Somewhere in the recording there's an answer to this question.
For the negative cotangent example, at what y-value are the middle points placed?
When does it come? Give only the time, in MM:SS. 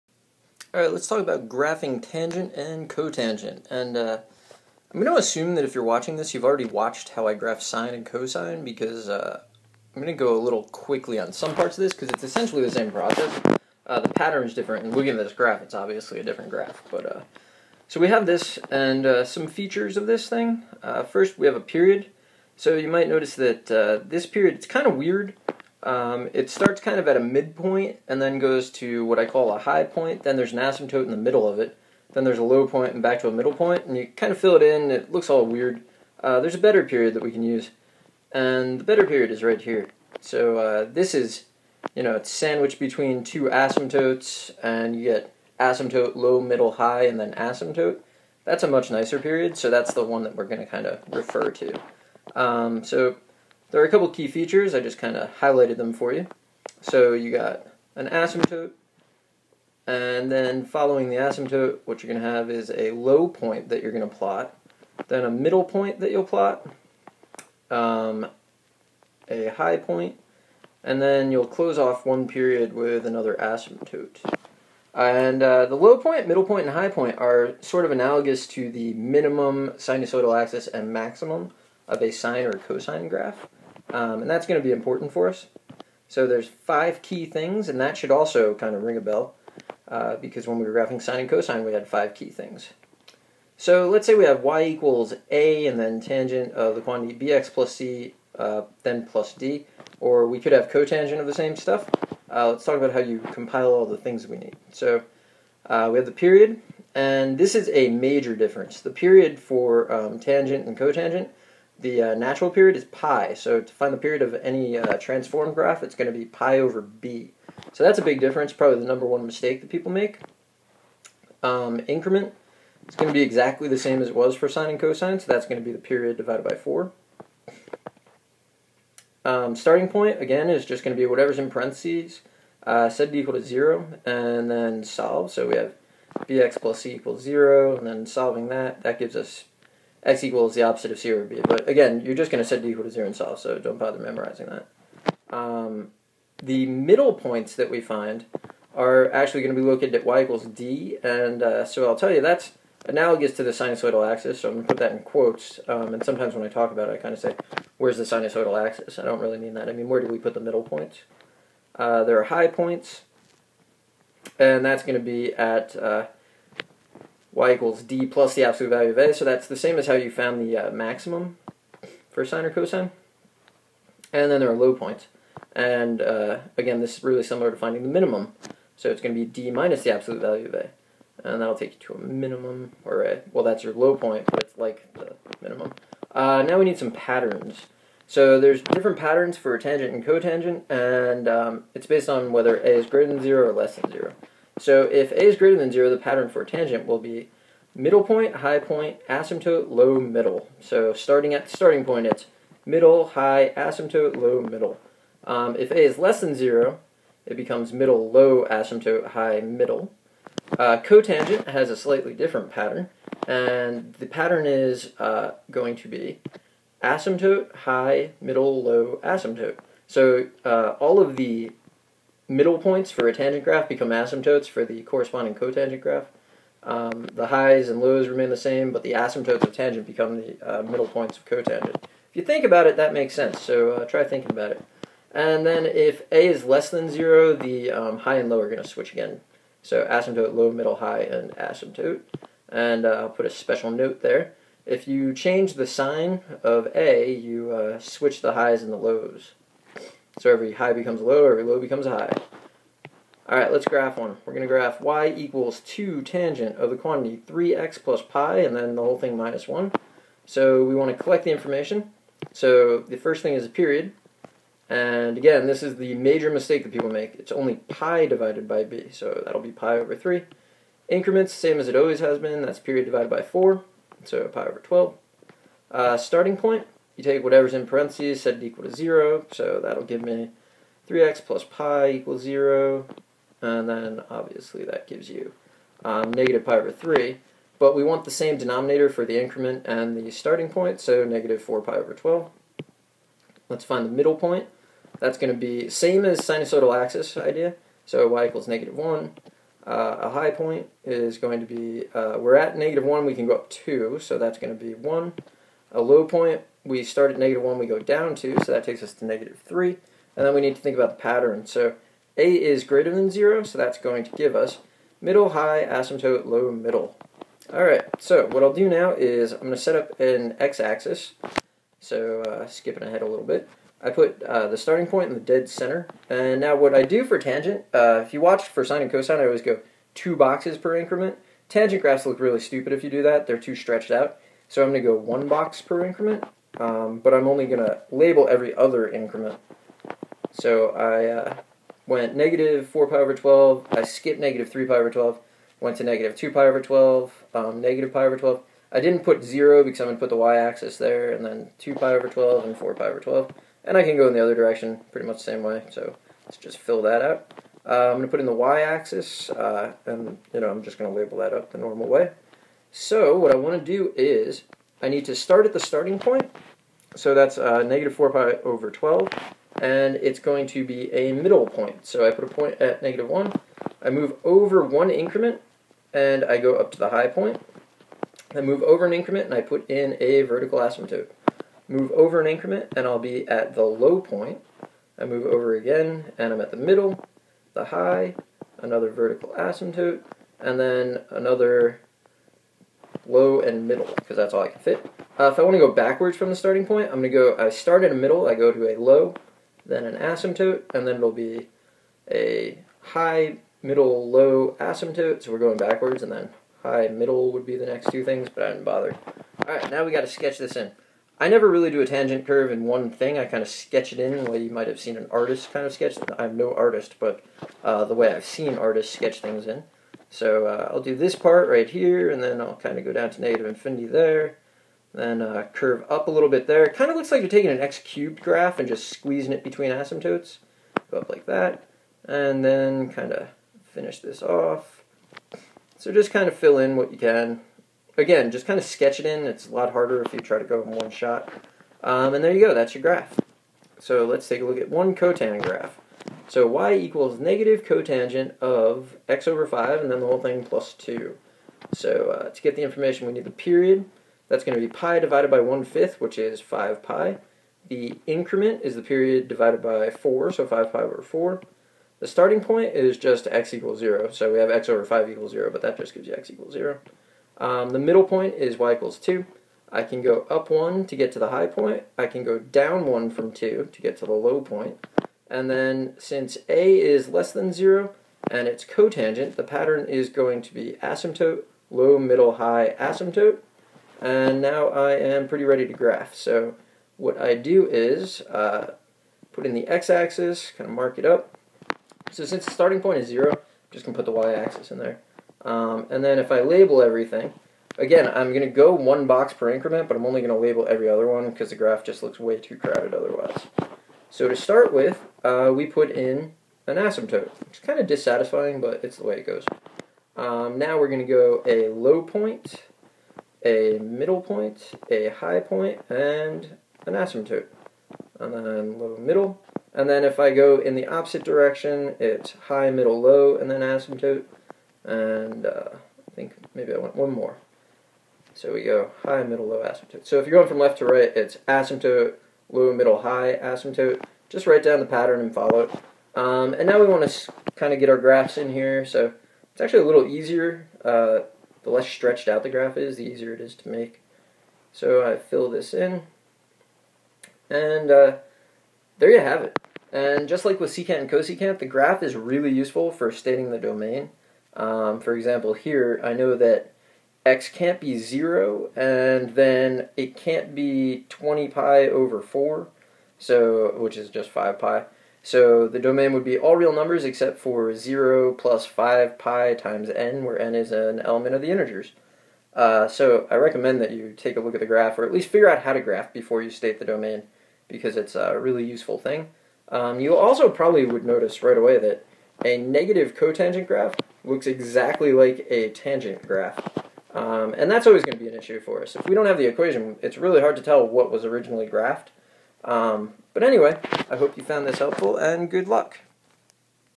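07:47.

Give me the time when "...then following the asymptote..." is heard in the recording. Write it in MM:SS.
01:00.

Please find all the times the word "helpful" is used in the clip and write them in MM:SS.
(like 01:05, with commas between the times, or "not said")
09:54.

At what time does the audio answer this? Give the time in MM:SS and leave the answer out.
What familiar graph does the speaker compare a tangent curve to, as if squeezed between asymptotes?
07:07.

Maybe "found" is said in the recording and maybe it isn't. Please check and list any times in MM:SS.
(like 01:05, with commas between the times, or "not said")
02:50, 09:54.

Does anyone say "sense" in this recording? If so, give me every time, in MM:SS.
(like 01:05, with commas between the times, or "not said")
03:53.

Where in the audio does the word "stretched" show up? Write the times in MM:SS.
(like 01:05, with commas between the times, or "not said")
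05:33, 09:01.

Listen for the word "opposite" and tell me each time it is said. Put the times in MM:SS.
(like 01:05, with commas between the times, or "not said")
02:20, 08:40.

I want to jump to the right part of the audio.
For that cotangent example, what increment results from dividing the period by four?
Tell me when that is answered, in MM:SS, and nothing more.
07:40.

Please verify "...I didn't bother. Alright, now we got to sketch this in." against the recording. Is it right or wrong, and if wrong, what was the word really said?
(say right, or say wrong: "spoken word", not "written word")
right.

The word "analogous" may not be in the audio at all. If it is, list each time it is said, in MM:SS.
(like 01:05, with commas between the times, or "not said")
01:17, 02:32.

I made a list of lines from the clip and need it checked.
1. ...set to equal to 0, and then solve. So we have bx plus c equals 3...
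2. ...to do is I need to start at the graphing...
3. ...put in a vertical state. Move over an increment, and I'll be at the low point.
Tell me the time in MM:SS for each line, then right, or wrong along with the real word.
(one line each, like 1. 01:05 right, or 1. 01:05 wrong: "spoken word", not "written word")
1. 02:12 wrong: "0", not "3"
2. 06:03 wrong: "starting", not "graphing"
3. 06:19 wrong: "asymptote", not "state".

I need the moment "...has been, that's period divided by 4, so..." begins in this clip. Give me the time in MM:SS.
04:32.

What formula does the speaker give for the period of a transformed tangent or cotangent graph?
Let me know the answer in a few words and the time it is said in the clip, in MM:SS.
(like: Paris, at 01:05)
pi over b, at 01:56.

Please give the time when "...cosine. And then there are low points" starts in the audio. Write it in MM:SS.
02:52.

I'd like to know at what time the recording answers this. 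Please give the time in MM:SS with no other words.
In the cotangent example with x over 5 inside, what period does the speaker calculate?
07:35.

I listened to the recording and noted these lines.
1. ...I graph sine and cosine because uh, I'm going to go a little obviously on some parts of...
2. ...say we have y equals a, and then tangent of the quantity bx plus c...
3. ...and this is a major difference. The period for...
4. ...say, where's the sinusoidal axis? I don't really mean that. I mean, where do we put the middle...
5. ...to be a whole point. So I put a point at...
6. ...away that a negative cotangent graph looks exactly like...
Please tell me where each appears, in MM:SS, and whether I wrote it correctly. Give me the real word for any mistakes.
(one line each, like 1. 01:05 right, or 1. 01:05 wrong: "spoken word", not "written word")
1. 00:07 wrong: "quickly", not "obviously"
2. 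01:34 right
3. 01:46 right
4. 02:37 right
5. 06:10 wrong: "middle", not "whole"
6. 09:41 right.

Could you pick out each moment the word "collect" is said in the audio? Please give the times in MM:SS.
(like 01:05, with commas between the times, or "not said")
04:21.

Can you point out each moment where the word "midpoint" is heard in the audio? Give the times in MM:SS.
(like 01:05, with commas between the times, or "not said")
00:27.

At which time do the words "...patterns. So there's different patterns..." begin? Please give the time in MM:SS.
03:06.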